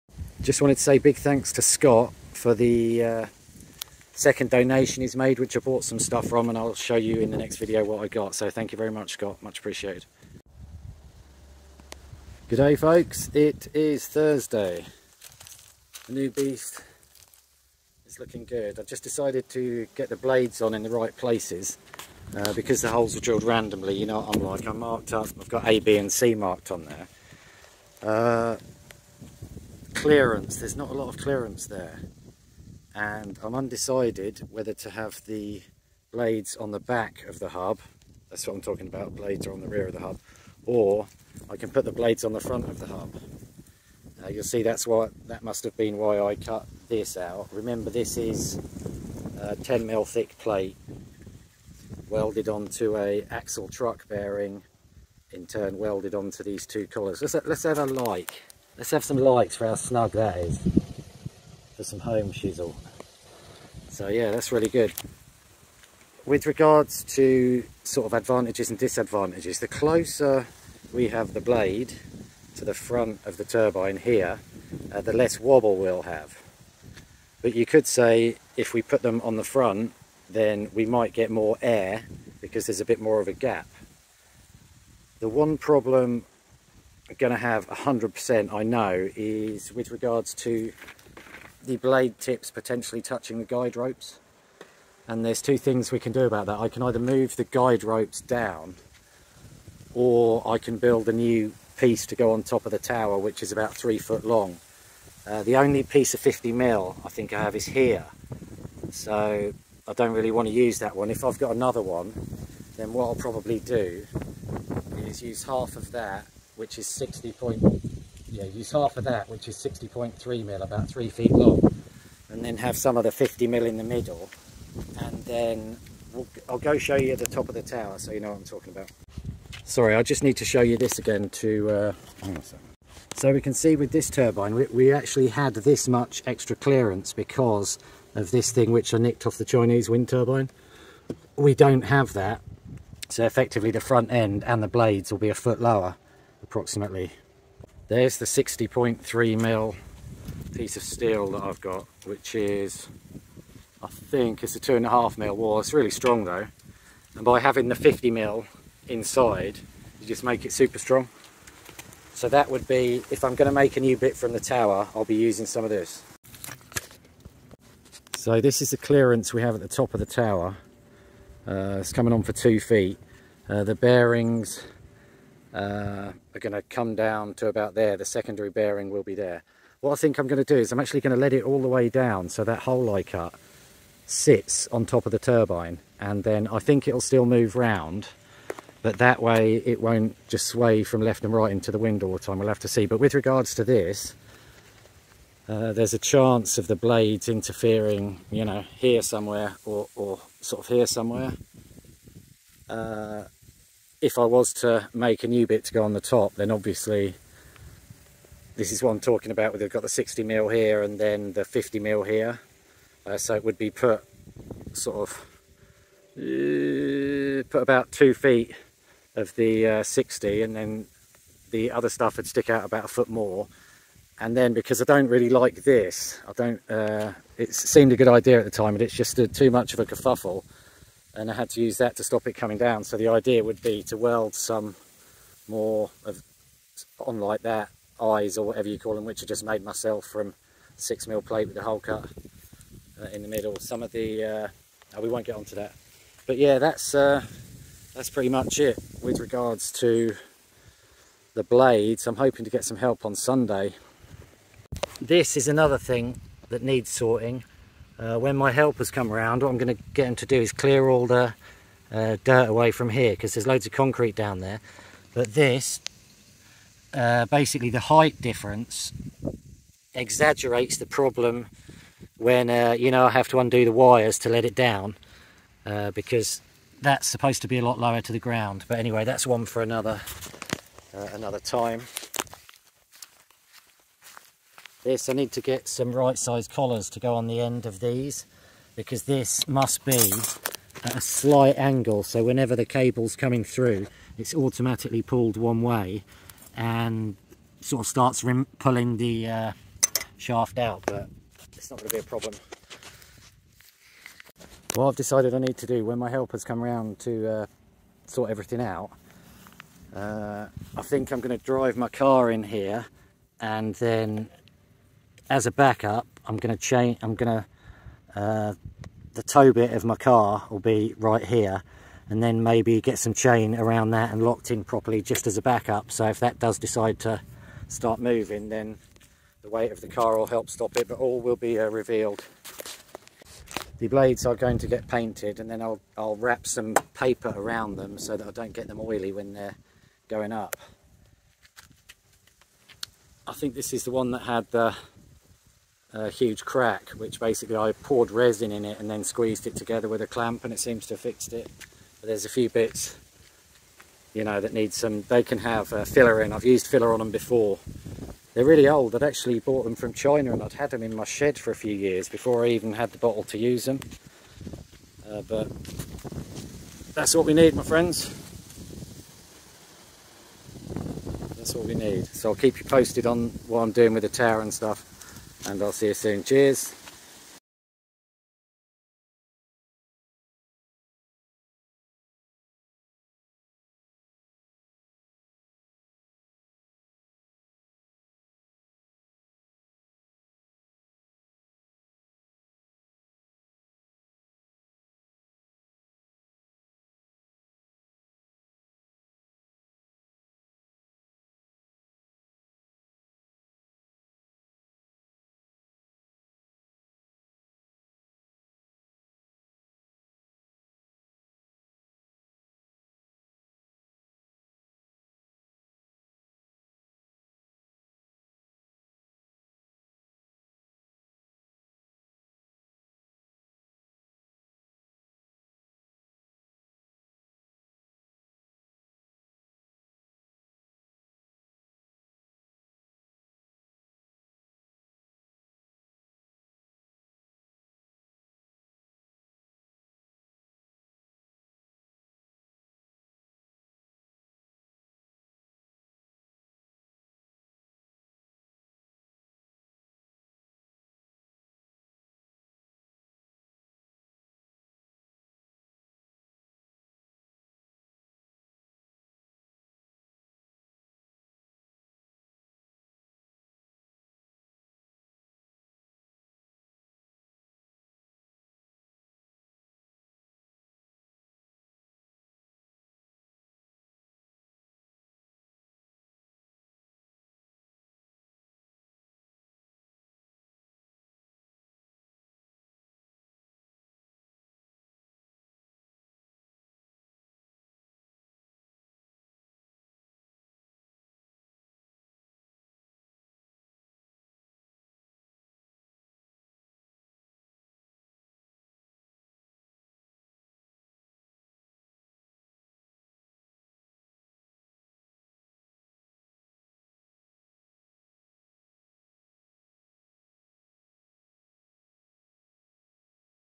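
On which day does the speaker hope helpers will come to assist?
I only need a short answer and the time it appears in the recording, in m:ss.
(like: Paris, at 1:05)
Sunday, at 4:13.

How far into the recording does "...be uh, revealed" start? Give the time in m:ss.
5:31.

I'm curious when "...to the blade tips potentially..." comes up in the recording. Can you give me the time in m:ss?
1:30.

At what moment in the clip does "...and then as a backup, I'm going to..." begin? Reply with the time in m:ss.
5:13.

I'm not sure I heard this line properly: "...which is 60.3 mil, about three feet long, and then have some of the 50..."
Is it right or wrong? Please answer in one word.
right.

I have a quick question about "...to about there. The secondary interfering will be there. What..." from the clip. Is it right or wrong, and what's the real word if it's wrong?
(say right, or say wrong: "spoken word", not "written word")
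wrong: "bearing", not "interfering".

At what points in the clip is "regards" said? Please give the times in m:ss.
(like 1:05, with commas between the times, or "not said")
1:06, 1:29, 3:13, 4:09.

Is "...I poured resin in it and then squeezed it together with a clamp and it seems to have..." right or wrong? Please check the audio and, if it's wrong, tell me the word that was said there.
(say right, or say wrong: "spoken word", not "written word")
right.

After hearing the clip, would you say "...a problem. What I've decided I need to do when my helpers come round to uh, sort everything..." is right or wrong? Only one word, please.
right.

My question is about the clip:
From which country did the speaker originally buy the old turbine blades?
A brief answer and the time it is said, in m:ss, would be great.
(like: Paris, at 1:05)
China, at 5:59.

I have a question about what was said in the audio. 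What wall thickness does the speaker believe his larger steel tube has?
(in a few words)
2.5 mm.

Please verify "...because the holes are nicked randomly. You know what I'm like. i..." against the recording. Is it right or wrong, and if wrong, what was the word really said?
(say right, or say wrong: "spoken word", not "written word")
wrong: "drilled", not "nicked".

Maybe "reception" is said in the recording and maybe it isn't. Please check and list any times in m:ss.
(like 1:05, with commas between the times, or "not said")
not said.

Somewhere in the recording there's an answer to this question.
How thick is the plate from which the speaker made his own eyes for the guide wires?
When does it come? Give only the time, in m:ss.
4:00.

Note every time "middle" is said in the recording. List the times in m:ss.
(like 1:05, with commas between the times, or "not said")
2:03, 4:03.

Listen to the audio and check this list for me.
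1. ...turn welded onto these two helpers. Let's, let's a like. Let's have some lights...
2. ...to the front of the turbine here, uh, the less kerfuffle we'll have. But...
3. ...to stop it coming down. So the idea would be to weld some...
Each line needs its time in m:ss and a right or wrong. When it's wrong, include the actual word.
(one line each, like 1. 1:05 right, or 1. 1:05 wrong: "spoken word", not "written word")
1. 0:55 wrong: "collars", not "helpers"
2. 1:12 wrong: "wobble", not "kerfuffle"
3. 3:51 right.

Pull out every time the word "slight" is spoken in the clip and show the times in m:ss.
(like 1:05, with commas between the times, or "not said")
4:51.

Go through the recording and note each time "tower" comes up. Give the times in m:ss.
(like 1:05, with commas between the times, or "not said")
1:42, 2:07, 2:44, 2:50, 6:14.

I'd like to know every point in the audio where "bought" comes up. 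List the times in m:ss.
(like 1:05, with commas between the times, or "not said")
0:05, 5:59.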